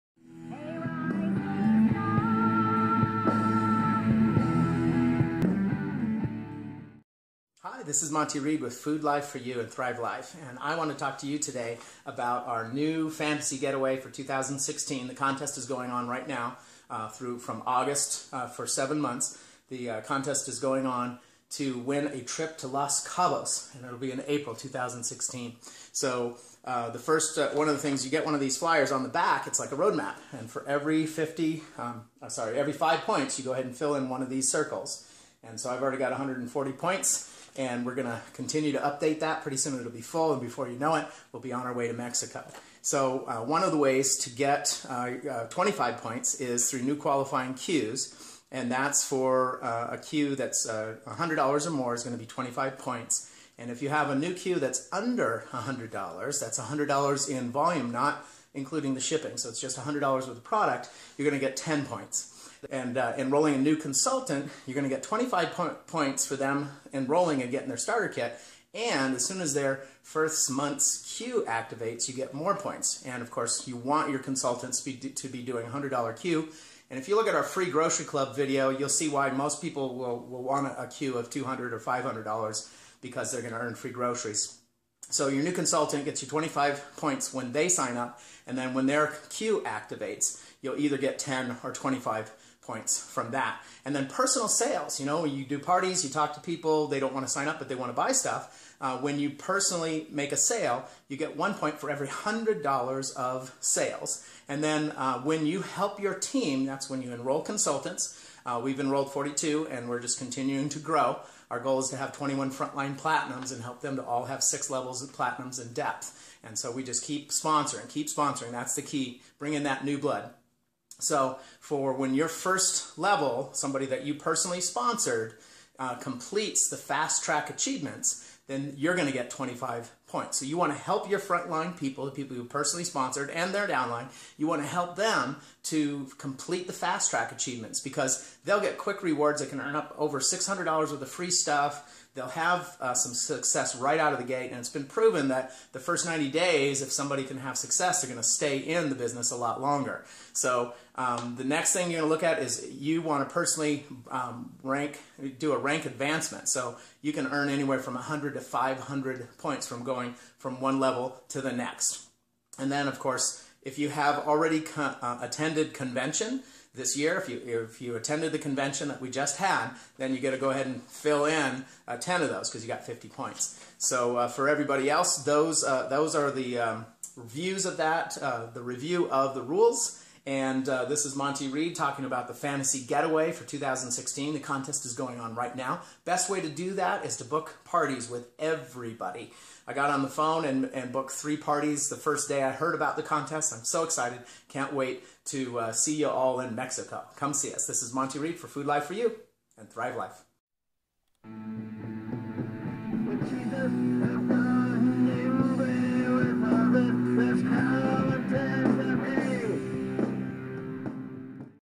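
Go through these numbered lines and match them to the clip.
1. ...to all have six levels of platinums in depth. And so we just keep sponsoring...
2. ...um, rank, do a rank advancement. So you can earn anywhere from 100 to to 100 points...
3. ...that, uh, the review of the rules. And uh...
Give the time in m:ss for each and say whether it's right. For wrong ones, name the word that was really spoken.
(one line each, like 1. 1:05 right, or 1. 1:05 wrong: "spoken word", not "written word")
1. 1:53 right
2. 2:34 wrong: "500", not "100"
3. 2:57 right.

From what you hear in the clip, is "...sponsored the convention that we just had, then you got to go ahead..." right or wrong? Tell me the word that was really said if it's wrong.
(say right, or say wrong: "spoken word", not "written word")
wrong: "attended", not "sponsored".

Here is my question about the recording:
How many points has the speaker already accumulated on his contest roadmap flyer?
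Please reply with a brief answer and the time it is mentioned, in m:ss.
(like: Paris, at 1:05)
140, at 0:36.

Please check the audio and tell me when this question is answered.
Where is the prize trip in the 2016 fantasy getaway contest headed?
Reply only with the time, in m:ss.
0:22.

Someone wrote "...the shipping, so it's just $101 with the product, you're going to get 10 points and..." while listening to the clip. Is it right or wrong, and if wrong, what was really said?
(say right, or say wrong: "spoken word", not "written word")
wrong: "100", not "101".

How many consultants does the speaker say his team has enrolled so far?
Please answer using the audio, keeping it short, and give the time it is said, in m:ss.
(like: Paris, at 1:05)
42, at 1:49.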